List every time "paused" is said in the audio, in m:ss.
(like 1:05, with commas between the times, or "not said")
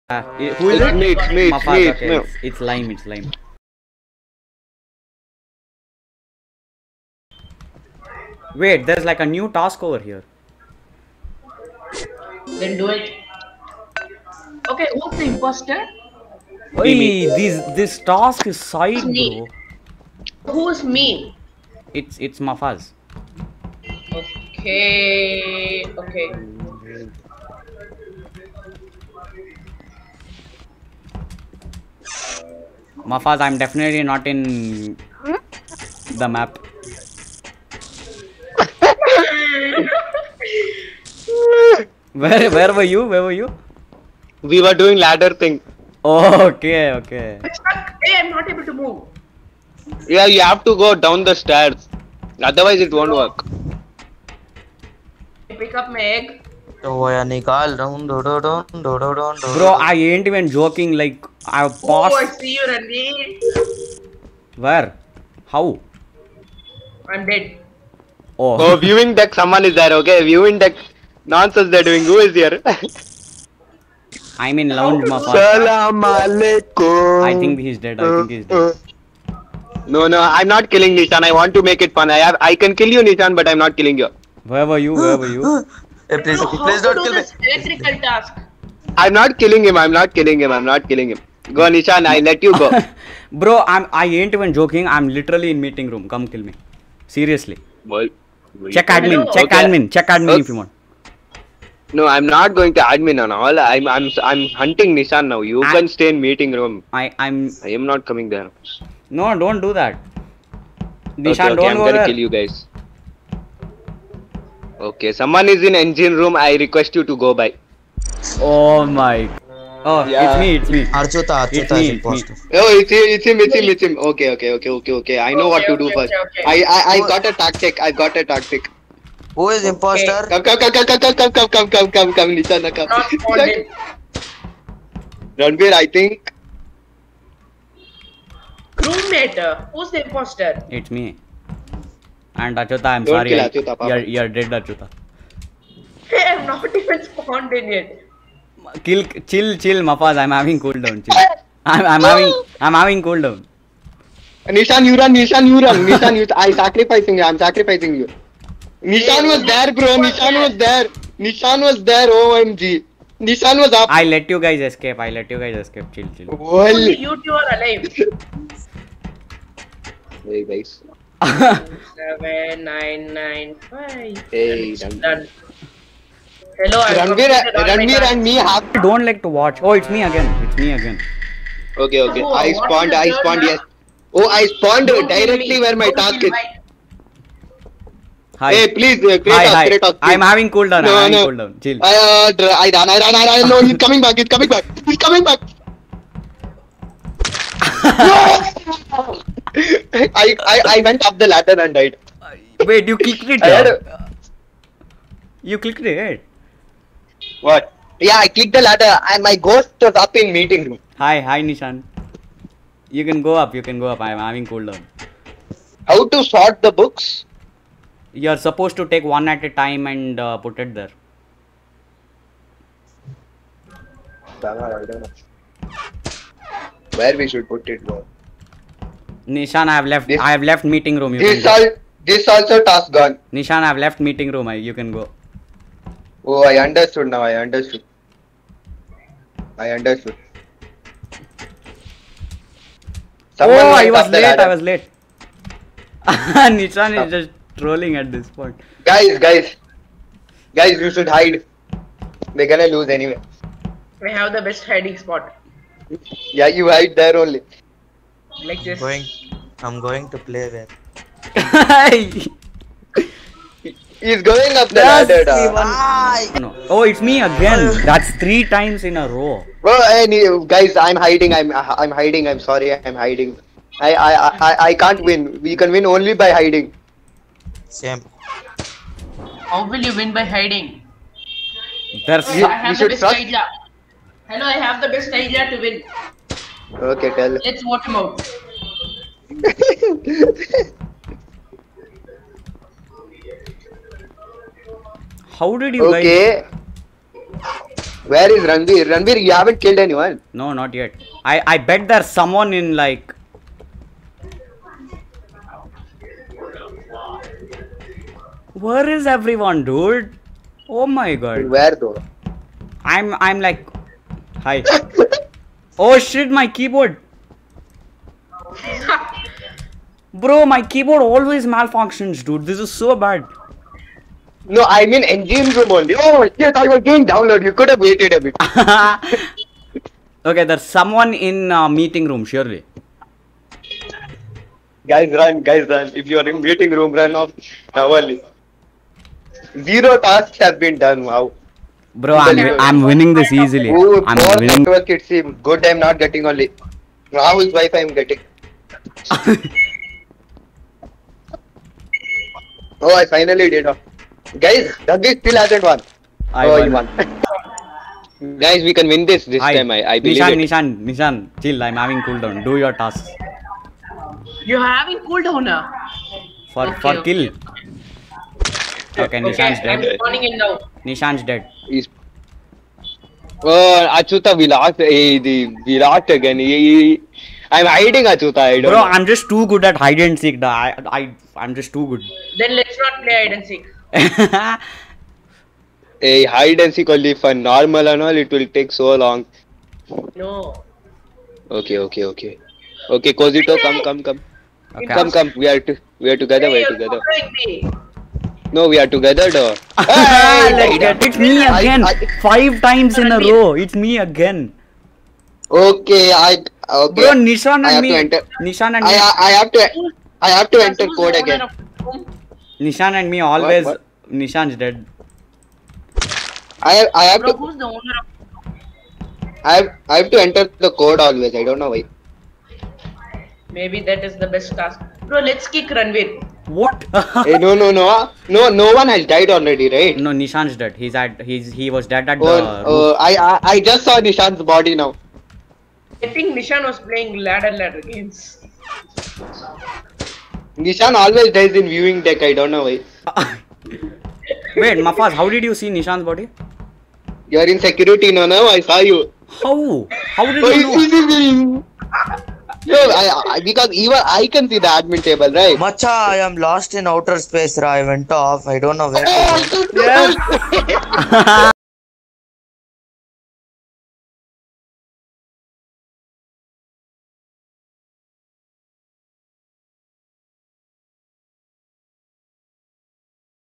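1:01.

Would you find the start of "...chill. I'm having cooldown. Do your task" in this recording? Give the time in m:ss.
6:01.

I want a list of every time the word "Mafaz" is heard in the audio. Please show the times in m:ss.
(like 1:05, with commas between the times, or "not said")
0:01, 0:22, 0:33, 2:29, 7:24.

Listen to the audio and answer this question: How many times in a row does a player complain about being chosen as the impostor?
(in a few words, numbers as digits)
5.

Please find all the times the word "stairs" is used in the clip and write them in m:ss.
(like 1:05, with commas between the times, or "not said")
0:51.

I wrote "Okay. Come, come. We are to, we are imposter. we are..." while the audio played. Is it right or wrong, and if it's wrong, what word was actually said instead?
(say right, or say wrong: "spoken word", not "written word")
wrong: "together", not "imposter".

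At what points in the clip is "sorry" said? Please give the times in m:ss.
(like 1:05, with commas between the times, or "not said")
2:23, 4:32.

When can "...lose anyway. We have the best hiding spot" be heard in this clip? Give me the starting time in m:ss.
4:12.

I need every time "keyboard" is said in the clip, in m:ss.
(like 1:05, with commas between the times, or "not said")
5:16, 5:20.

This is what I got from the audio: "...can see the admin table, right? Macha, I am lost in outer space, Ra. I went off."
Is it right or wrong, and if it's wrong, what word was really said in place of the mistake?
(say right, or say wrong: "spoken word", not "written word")
right.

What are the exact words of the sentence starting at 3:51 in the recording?
You this, this also task gone.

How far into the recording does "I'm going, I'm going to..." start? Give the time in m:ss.
4:18.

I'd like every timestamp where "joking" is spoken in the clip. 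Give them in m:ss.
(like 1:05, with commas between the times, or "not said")
1:00, 1:34.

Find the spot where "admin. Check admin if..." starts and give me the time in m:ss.
1:39.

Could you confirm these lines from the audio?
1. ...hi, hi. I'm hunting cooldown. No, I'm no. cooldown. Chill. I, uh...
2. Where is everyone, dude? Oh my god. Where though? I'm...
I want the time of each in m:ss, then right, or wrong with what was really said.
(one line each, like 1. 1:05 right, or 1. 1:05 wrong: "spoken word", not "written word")
1. 3:09 wrong: "having", not "hunting"
2. 5:08 right.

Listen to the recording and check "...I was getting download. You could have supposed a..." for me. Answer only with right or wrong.
wrong.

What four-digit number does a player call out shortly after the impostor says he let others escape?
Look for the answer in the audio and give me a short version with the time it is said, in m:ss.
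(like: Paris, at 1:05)
7995, at 2:51.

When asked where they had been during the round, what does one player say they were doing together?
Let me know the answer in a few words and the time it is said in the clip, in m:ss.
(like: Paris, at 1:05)
ladder thing, at 0:44.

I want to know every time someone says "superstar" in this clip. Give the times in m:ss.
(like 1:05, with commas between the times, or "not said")
not said.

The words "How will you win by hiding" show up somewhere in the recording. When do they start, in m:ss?
4:39.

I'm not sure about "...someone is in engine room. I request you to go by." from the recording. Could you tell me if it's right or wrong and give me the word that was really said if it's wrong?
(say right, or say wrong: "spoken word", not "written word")
right.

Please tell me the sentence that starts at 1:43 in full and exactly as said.
I'm I'm I'm hunting Nishan now.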